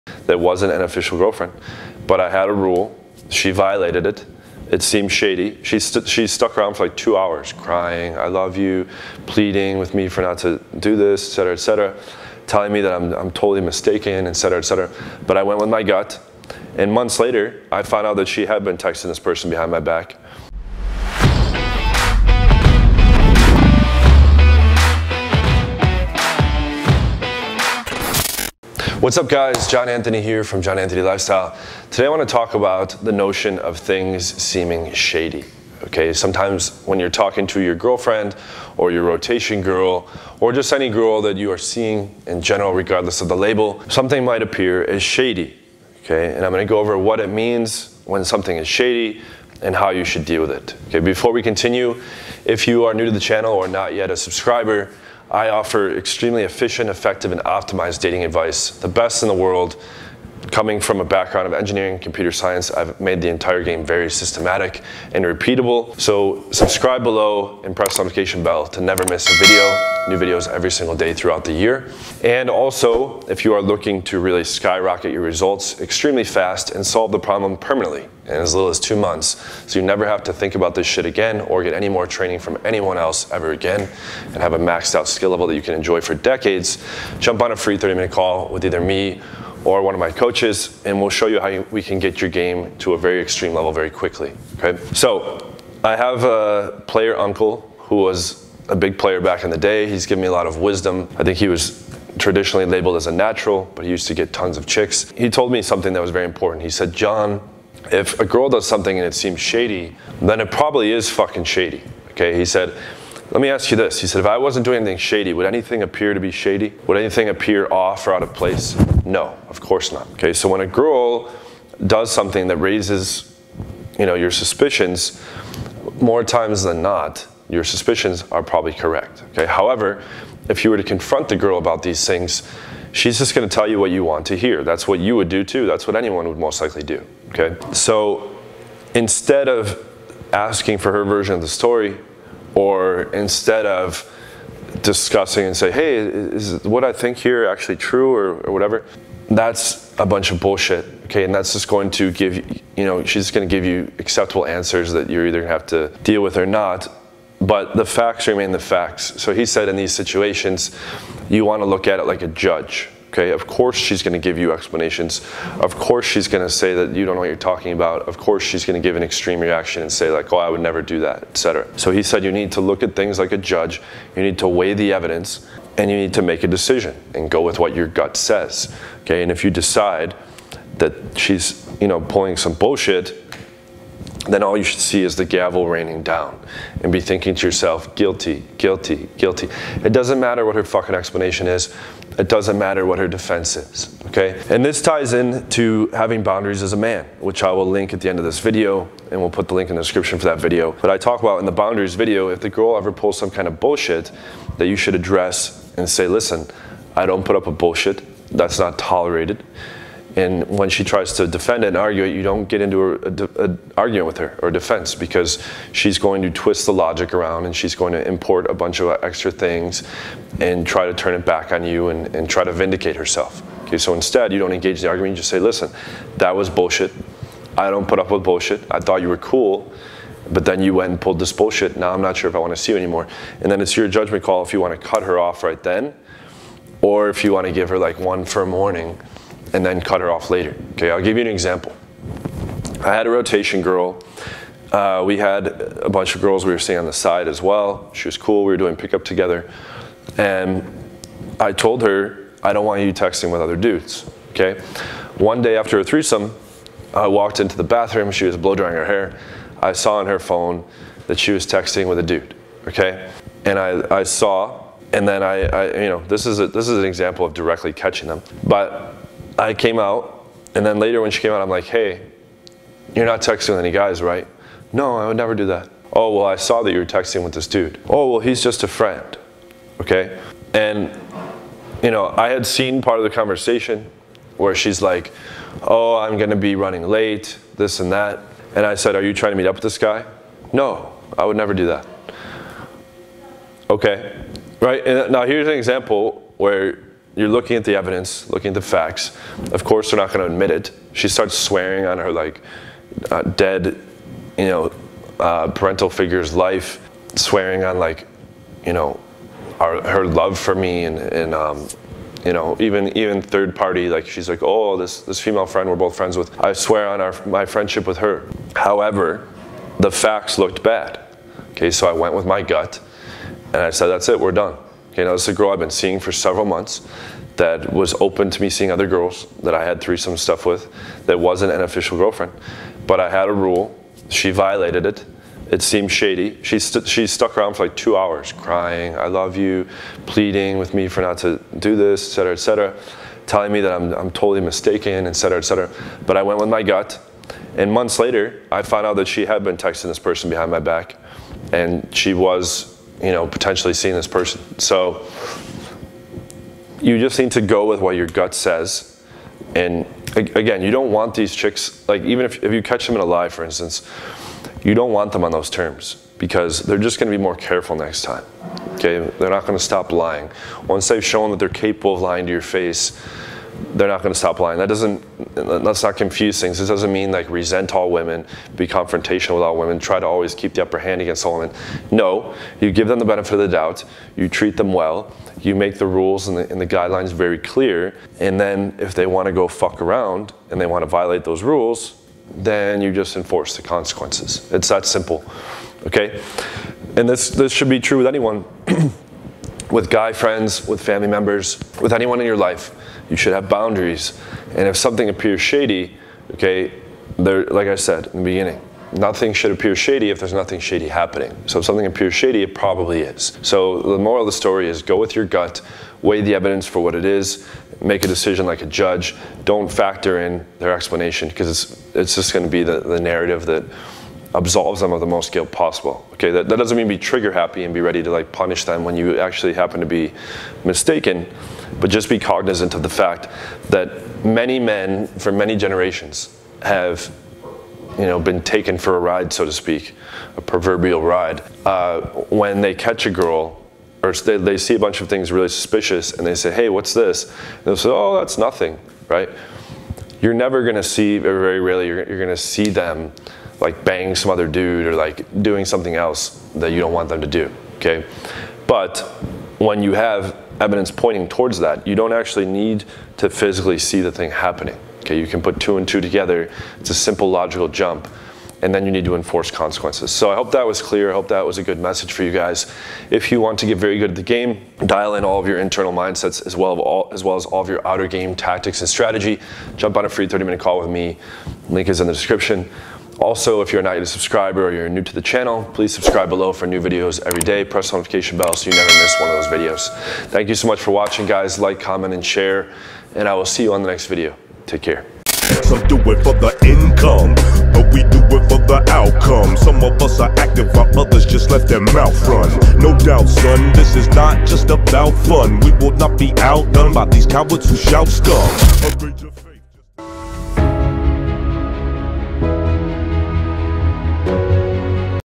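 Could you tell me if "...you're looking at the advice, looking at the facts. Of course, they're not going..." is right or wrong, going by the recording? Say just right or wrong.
wrong.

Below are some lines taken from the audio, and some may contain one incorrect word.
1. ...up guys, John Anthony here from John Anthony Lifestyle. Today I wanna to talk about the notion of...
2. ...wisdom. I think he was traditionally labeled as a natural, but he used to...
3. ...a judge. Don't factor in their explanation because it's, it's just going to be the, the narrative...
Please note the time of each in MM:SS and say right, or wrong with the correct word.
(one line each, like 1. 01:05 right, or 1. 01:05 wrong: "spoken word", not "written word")
1. 00:29 right
2. 01:40 right
3. 06:58 right.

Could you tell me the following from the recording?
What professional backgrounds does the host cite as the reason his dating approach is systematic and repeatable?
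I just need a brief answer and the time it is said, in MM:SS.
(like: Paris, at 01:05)
engineering, computer science, at 01:01.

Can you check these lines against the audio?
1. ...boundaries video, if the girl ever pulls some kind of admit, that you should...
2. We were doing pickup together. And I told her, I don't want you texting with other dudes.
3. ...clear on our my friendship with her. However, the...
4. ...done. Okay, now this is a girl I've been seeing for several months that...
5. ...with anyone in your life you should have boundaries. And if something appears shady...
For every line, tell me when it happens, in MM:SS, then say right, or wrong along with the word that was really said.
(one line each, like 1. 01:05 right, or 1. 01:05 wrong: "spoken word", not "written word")
1. 03:21 wrong: "bullshit", not "admit"
2. 04:08 right
3. 05:16 wrong: "swear", not "clear"
4. 05:24 right
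5. 06:41 right.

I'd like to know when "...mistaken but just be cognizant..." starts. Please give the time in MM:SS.
07:10.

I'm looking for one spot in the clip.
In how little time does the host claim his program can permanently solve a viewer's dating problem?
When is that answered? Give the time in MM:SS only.
01:18.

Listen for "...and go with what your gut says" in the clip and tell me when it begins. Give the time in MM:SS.
02:57.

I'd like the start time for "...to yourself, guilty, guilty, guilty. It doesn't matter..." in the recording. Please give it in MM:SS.
03:07.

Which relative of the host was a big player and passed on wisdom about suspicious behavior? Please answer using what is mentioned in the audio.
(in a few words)
uncle.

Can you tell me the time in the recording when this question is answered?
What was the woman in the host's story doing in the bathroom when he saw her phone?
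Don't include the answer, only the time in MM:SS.
04:18.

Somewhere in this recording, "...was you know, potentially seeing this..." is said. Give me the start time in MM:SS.
05:52.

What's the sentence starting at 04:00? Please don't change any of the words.
Okay, I'll give you an example.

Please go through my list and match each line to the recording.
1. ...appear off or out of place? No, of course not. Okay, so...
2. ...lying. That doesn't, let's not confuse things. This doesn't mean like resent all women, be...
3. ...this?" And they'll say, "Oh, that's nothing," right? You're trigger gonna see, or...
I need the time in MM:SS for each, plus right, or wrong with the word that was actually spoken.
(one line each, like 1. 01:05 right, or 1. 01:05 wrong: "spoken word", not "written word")
1. 01:57 right
2. 06:14 right
3. 07:26 wrong: "never", not "trigger".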